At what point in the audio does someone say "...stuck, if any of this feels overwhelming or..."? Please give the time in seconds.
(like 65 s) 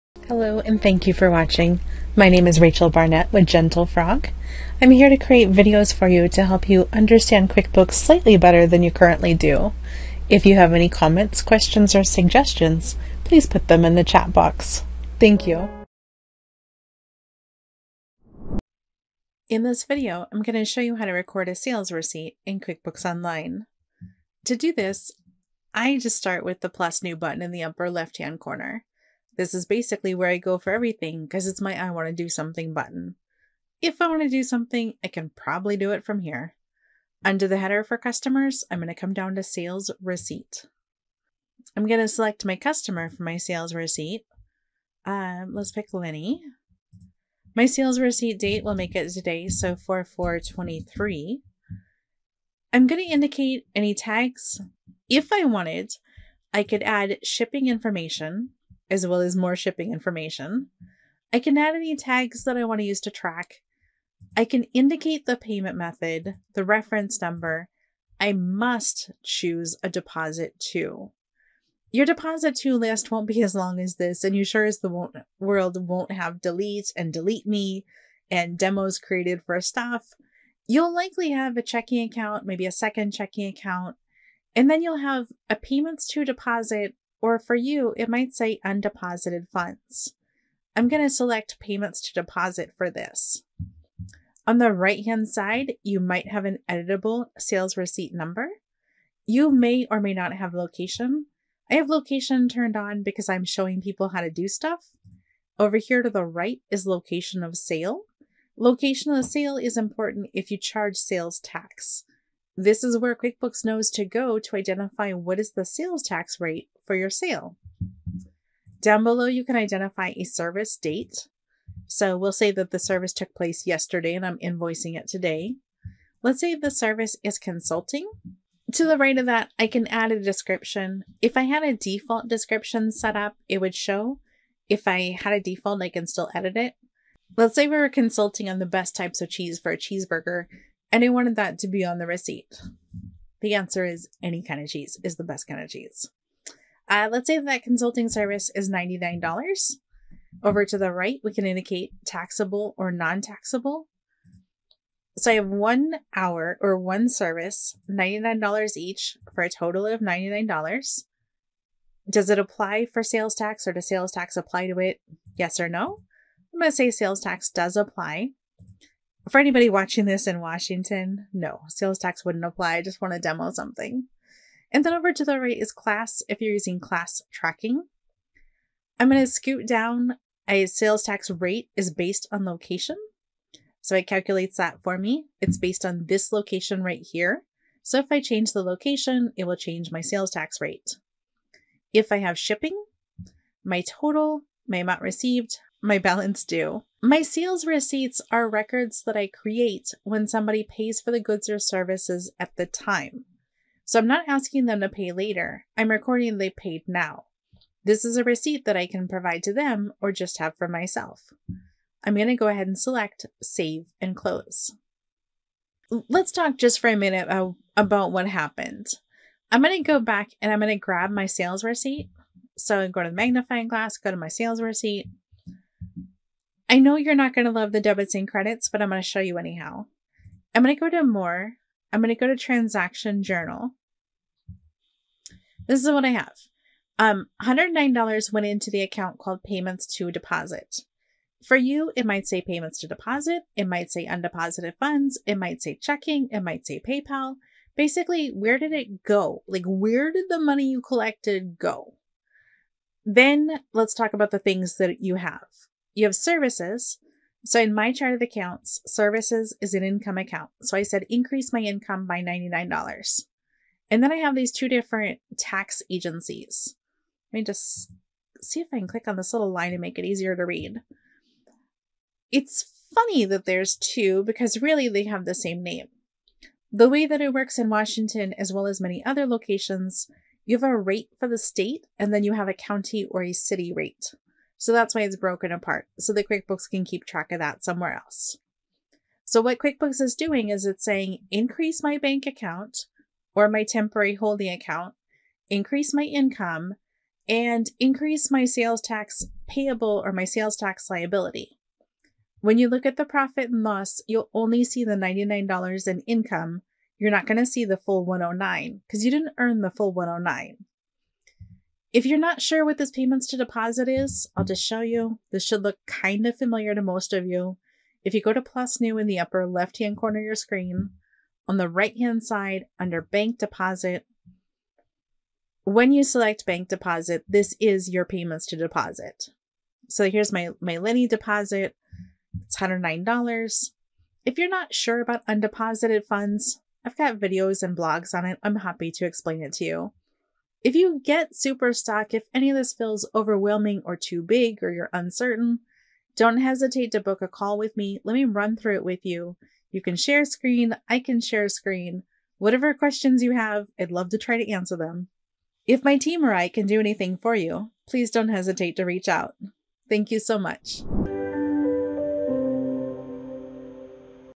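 341 s.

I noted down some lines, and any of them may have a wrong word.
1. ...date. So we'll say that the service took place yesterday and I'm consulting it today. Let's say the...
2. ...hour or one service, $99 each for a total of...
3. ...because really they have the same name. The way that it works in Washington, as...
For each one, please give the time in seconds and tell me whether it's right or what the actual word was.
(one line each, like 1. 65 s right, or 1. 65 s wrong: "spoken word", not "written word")
1. 120 s wrong: "invoicing", not "consulting"
2. 156 s right
3. 274 s right.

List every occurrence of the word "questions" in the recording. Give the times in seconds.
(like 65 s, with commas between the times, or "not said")
11 s, 352 s.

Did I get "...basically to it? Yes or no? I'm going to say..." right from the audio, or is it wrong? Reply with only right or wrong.
wrong.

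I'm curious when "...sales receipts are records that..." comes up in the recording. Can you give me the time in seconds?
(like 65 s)
197 s.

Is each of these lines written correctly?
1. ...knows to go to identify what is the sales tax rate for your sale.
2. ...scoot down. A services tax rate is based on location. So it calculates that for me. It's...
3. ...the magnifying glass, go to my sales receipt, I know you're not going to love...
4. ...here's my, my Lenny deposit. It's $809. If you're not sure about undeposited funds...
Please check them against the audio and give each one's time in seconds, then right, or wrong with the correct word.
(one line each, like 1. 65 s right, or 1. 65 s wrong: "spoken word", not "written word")
1. 113 s right
2. 179 s wrong: "sales", not "services"
3. 223 s right
4. 330 s wrong: "109", not "809".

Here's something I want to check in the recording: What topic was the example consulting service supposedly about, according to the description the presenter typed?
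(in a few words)
cheese for a cheeseburger.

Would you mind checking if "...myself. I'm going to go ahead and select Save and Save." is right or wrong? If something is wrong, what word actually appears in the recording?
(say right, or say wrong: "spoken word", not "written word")
wrong: "Close", not "Save".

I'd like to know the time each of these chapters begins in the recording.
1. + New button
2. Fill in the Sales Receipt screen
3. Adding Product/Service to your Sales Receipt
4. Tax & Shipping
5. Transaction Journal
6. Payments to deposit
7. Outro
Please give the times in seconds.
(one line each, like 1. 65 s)
1. 18 s
2. 40 s
3. 117 s
4. 177 s
5. 215 s
6. 311 s
7. 355 s.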